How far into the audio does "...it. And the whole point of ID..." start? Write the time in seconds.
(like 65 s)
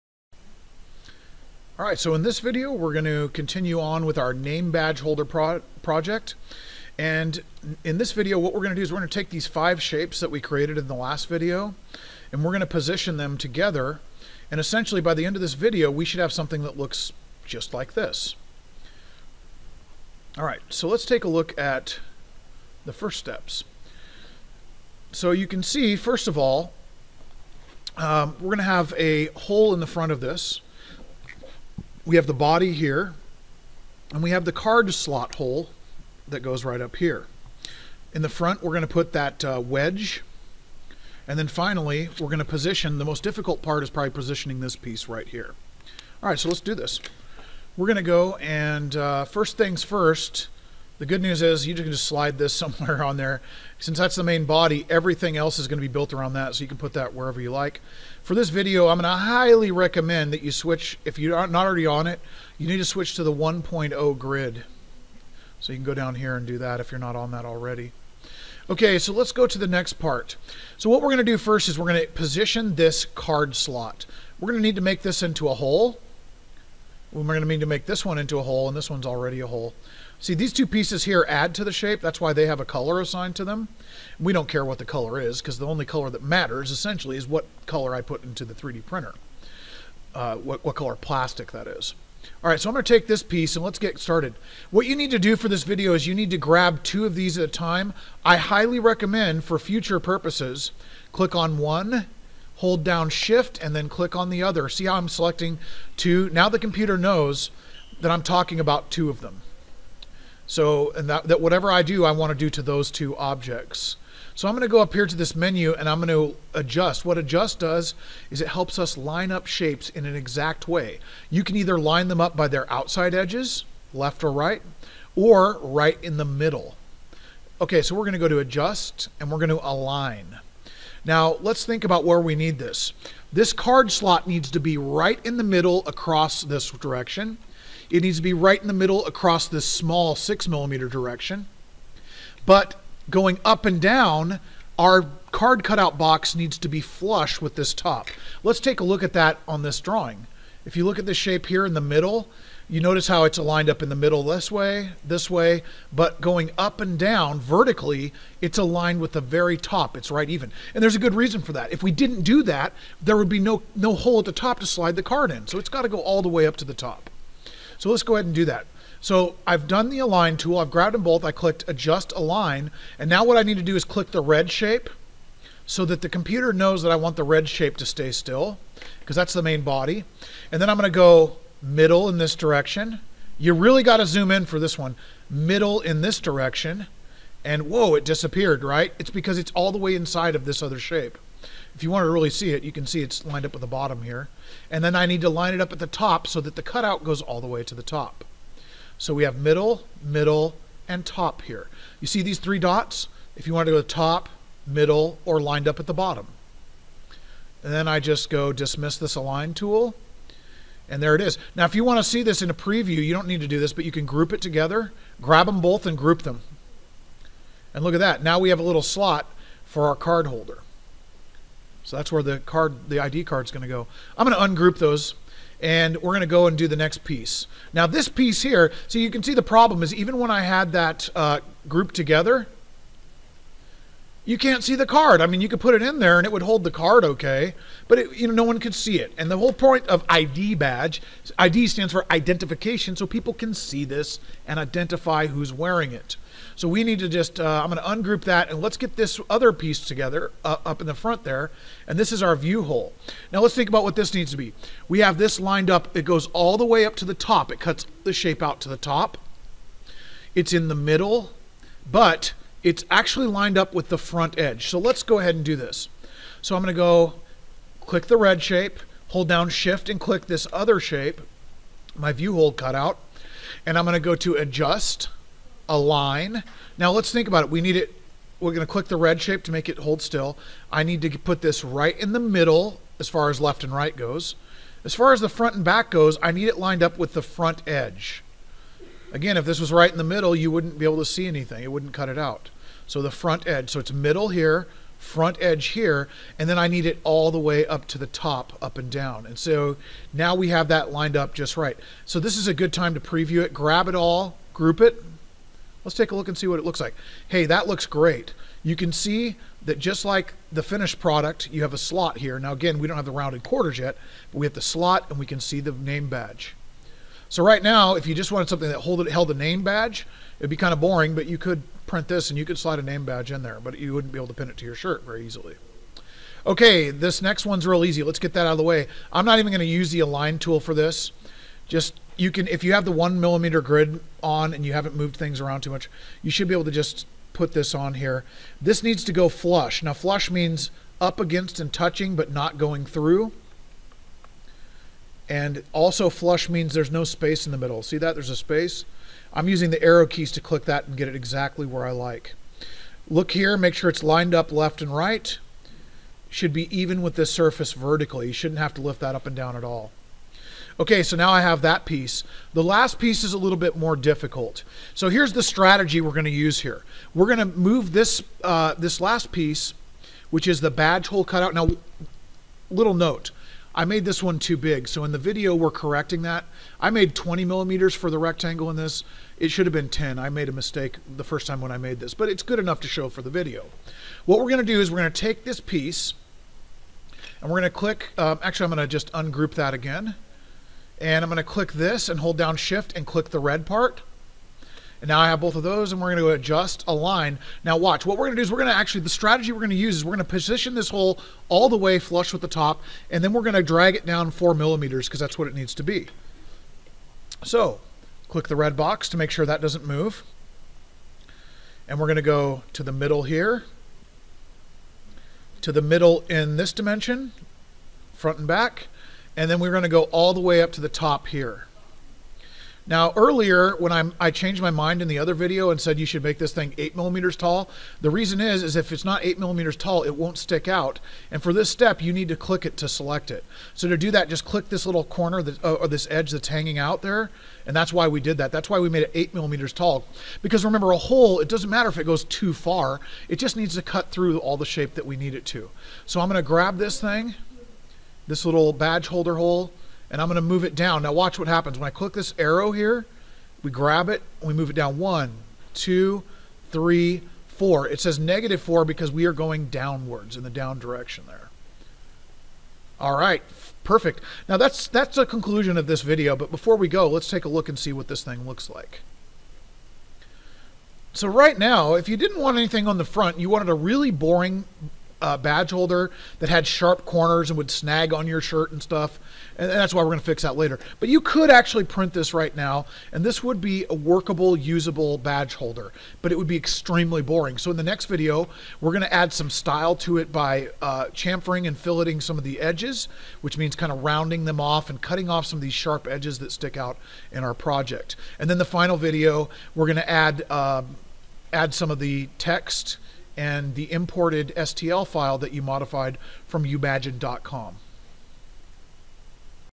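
238 s.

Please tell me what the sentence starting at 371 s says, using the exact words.
Now, little note, I made this one too big.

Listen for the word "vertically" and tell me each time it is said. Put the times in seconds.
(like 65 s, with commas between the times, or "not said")
157 s, 357 s.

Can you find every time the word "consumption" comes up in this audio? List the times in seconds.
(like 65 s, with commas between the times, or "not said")
not said.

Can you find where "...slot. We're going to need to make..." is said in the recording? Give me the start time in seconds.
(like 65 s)
73 s.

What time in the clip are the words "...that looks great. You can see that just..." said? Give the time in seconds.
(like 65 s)
307 s.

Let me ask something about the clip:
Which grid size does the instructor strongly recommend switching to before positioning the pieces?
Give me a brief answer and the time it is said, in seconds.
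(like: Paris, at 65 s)
1.0 grid, at 63 s.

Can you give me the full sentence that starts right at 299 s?
And so now we have that lined up just right.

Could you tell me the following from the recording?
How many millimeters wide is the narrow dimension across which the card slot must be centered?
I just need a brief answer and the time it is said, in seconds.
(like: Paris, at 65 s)
6 millimeters, at 140 s.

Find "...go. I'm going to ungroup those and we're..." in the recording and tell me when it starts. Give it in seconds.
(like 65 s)
223 s.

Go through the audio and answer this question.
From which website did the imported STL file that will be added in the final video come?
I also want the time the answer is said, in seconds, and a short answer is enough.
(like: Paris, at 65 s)
youmagine.com, at 506 s.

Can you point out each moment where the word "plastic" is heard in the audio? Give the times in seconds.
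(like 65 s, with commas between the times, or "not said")
90 s.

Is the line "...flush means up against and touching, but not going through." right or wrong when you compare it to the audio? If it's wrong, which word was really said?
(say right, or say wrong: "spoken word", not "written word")
right.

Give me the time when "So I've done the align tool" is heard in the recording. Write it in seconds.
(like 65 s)
169 s.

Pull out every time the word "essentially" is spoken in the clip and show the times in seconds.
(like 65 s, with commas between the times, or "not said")
14 s, 86 s.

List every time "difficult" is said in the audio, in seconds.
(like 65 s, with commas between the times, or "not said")
43 s, 363 s.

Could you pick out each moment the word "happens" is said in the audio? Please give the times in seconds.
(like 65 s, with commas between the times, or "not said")
451 s.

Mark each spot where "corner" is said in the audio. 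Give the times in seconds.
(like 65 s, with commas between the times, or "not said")
435 s, 477 s.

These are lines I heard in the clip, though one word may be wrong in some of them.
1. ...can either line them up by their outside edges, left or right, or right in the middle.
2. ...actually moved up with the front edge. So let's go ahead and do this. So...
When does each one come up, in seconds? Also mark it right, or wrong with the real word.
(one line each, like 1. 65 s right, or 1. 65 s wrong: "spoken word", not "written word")
1. 121 s right
2. 262 s wrong: "lined", not "moved".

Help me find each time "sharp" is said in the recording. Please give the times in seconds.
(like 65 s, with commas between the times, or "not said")
476 s, 495 s.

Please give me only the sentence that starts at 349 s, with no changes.
I'm using the arrow keys to click that and get it exactly where I like.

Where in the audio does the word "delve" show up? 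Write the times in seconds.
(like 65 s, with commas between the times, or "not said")
not said.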